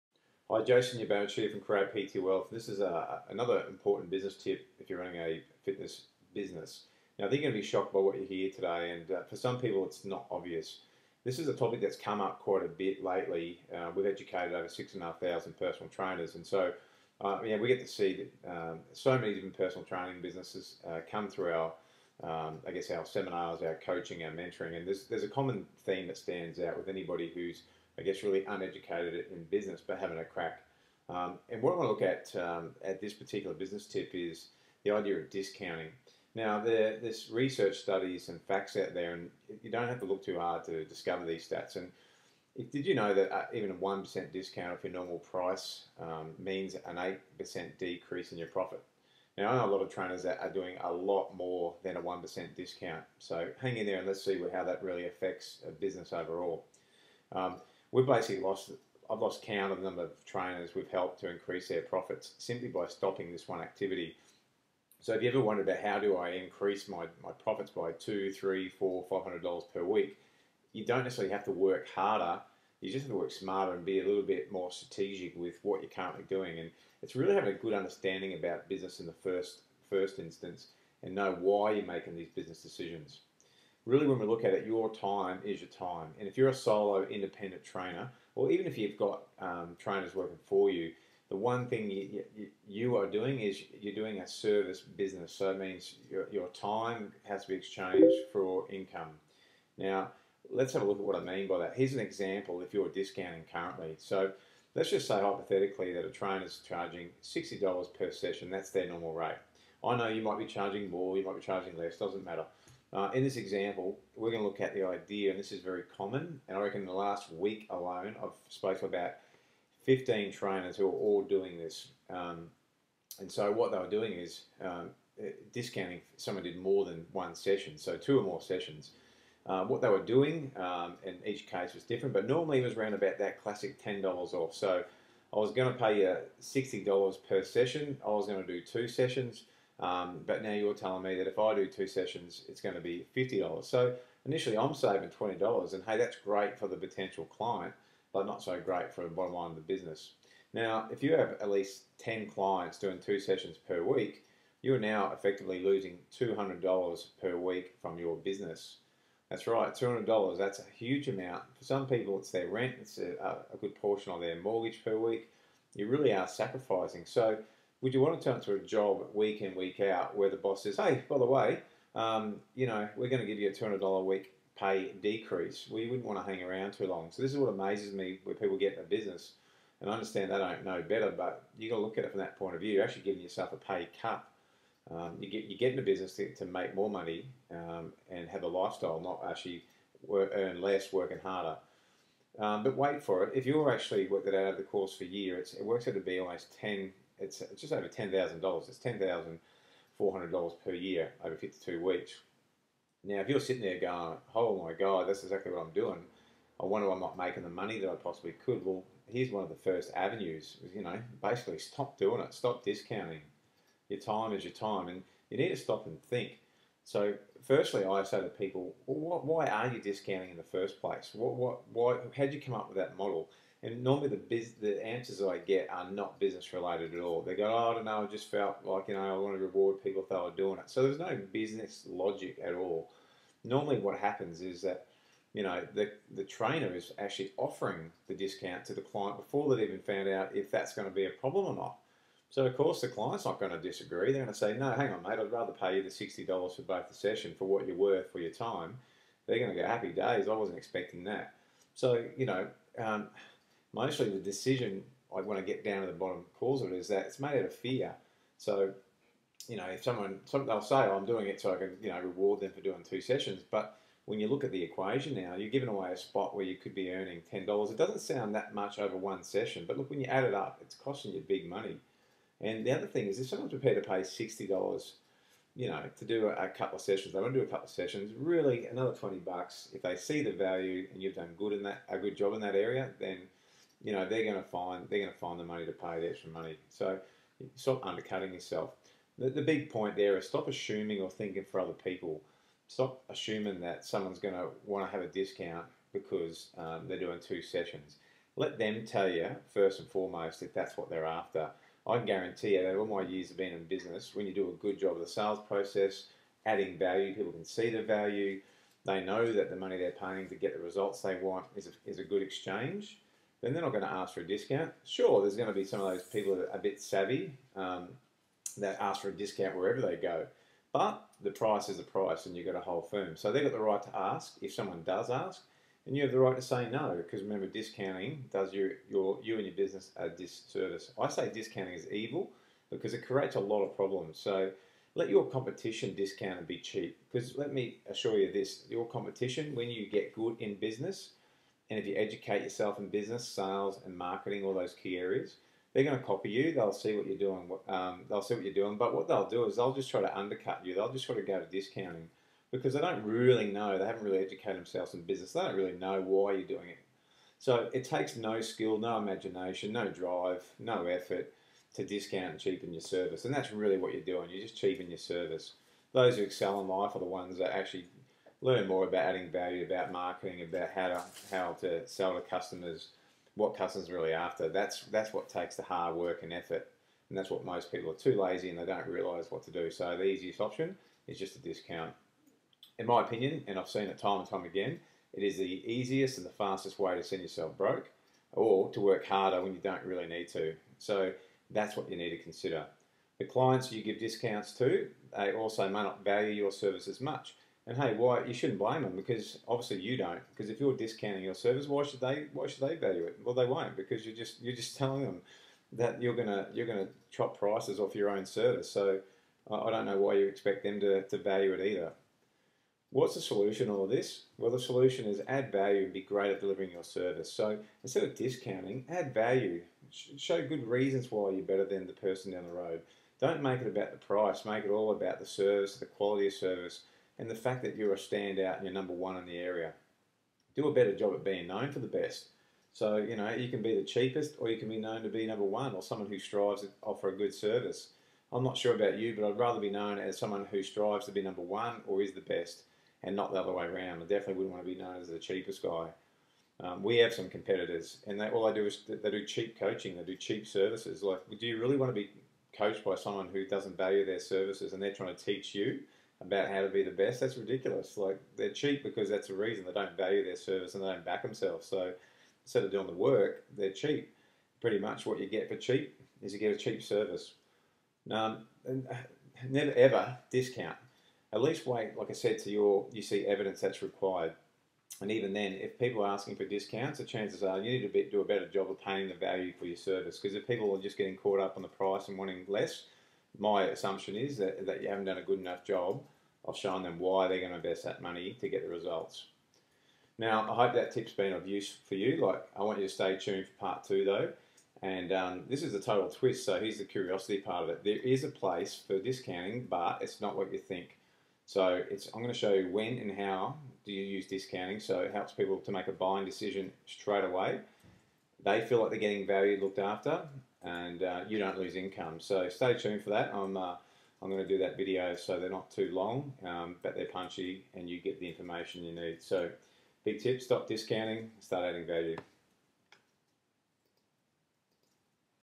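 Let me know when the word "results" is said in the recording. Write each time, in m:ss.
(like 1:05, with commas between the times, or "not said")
5:10, 8:08.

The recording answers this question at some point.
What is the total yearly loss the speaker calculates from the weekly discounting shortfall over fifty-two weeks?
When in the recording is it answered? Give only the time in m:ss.
3:18.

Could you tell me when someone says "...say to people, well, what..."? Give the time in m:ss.
3:38.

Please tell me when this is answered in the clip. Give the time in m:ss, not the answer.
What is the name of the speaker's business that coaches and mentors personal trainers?
0:01.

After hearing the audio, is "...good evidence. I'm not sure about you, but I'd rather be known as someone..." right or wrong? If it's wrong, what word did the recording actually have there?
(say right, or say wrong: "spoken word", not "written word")
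wrong: "service", not "evidence".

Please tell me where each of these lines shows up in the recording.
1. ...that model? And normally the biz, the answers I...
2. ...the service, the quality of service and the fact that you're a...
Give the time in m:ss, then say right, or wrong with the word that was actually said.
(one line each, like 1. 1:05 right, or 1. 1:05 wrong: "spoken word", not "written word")
1. 3:42 right
2. 7:05 right.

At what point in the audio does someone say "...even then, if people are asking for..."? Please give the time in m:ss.
7:55.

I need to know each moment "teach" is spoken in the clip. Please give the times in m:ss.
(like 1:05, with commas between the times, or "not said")
7:35.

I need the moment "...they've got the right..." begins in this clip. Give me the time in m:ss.
5:23.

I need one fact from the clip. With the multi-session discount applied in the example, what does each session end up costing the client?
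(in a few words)
$50.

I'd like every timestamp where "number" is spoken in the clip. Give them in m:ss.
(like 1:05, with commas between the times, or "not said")
0:59, 7:08, 7:15, 7:21.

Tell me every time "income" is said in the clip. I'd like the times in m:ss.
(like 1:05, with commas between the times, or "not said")
1:38, 8:31.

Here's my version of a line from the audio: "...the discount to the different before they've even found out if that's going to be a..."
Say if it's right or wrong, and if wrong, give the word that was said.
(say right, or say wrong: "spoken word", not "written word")
wrong: "client", not "different".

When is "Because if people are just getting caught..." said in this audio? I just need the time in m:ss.
8:00.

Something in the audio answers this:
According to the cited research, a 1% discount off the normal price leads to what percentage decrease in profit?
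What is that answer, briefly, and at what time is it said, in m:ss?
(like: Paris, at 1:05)
8%, at 0:46.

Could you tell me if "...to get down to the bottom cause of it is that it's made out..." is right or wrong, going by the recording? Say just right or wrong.
right.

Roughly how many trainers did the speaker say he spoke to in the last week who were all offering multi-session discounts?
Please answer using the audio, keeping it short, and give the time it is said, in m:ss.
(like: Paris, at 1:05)
15, at 1:59.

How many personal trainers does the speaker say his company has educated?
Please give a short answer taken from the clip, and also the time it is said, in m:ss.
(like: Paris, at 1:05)
6,500, at 0:14.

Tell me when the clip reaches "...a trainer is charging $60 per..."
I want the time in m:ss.
1:46.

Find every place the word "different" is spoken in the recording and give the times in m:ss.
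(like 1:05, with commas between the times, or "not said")
0:19, 2:11.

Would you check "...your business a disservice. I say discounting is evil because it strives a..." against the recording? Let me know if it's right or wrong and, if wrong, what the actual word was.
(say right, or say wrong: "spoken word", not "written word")
wrong: "creates", not "strives".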